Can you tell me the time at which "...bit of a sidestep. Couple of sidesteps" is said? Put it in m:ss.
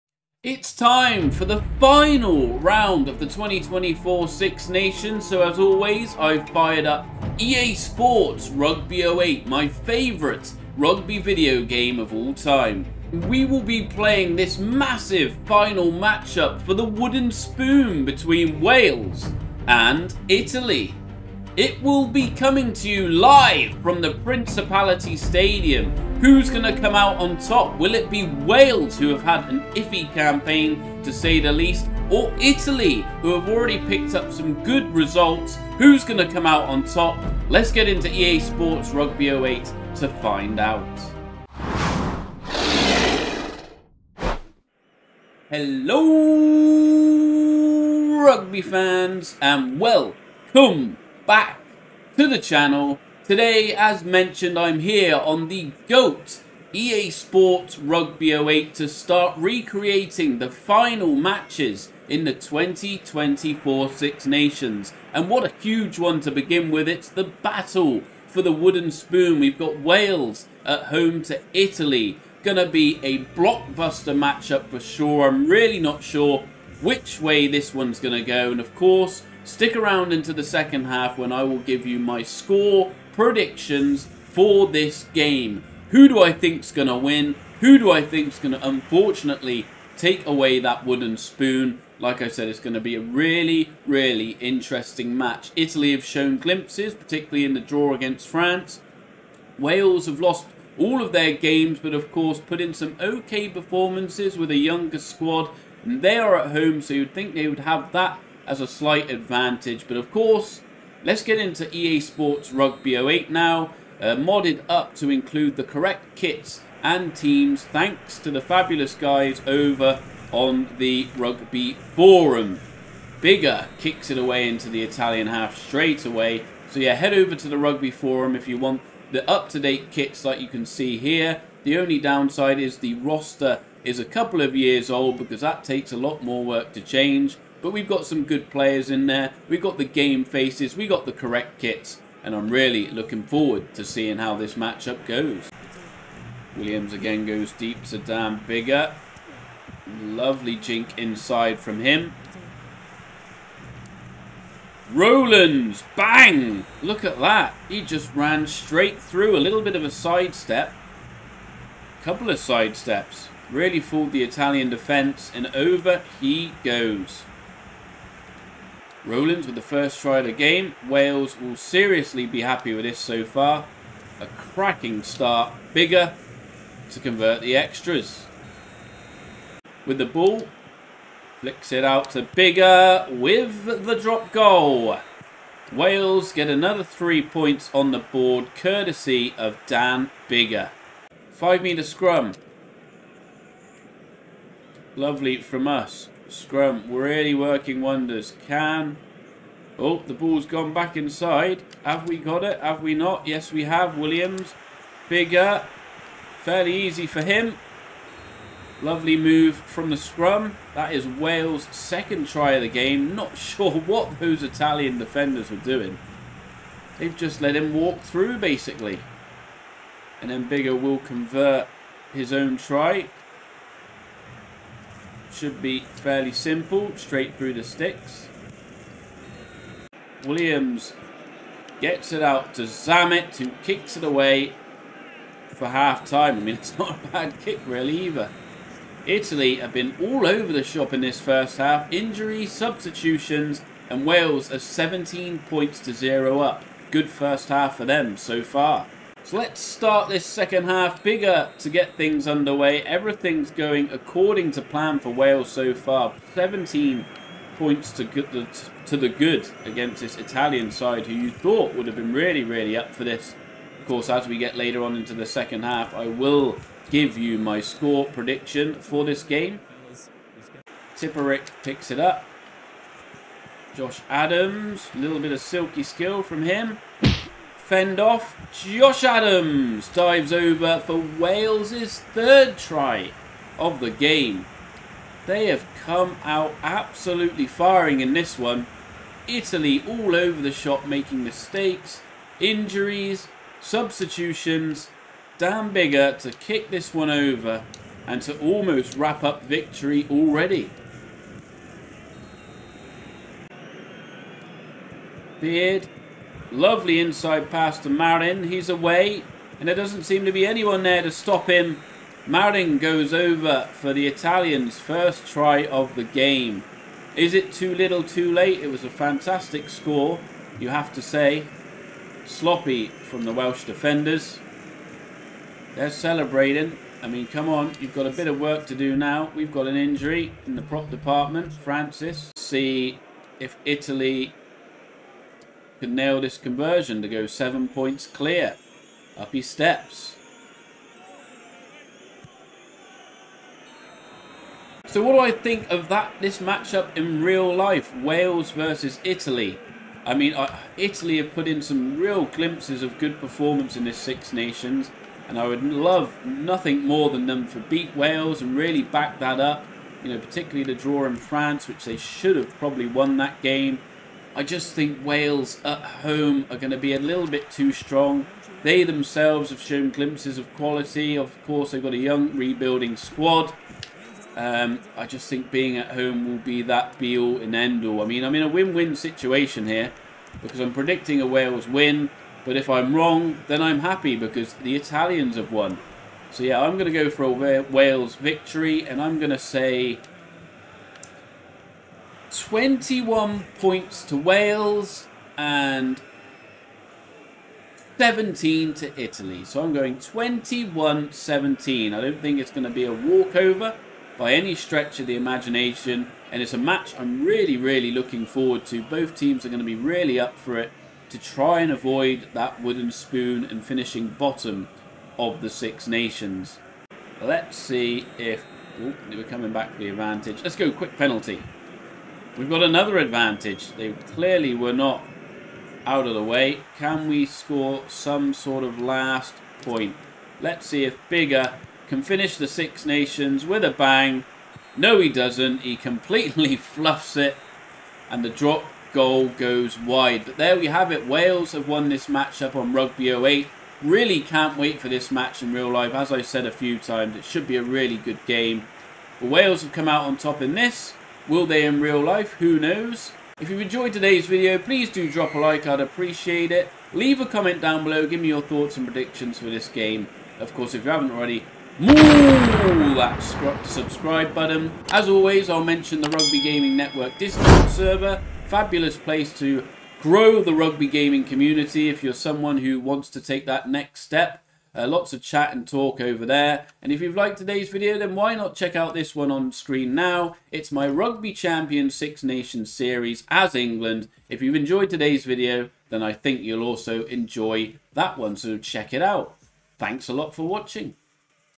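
2:39.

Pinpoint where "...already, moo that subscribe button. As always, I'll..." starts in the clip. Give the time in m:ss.
7:41.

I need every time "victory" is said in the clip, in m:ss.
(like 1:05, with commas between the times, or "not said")
4:59, 6:28.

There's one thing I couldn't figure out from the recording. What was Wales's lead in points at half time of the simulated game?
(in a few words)
17.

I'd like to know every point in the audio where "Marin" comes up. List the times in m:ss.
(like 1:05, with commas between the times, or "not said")
5:07, 5:12.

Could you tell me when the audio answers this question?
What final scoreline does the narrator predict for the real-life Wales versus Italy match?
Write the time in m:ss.
6:39.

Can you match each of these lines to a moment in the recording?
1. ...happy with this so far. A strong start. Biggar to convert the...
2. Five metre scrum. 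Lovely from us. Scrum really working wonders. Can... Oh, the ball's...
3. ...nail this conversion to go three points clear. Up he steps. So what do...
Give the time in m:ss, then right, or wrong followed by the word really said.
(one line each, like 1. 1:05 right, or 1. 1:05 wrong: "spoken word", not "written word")
1. 2:52 wrong: "cracking", not "strong"
2. 3:11 right
3. 5:35 wrong: "seven", not "three".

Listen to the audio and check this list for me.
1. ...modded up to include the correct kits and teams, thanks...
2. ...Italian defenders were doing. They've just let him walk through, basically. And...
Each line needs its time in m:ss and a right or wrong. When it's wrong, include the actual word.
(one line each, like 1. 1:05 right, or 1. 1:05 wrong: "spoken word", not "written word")
1. 1:54 right
2. 3:34 right.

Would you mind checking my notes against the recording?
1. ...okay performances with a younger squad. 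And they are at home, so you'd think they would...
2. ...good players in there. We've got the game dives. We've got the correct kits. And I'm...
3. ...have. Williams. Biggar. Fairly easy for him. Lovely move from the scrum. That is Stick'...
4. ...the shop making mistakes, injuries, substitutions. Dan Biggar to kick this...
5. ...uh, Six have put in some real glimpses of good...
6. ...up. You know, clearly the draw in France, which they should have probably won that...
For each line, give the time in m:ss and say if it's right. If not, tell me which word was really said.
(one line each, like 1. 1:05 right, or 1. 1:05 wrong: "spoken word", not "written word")
1. 1:42 right
2. 2:18 wrong: "faces", not "dives"
3. 3:23 wrong: "Wales", not "Stick"
4. 4:50 right
5. 5:50 wrong: "Italy", not "Six"
6. 5:59 wrong: "particularly", not "clearly".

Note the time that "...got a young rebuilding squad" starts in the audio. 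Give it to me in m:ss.
6:11.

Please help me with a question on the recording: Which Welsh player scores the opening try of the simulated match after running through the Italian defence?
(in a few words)
Rowlands.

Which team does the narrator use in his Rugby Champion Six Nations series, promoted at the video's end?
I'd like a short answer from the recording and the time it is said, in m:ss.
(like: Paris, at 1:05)
England, at 8:03.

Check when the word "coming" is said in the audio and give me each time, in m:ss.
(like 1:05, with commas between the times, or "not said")
0:22, 6:59.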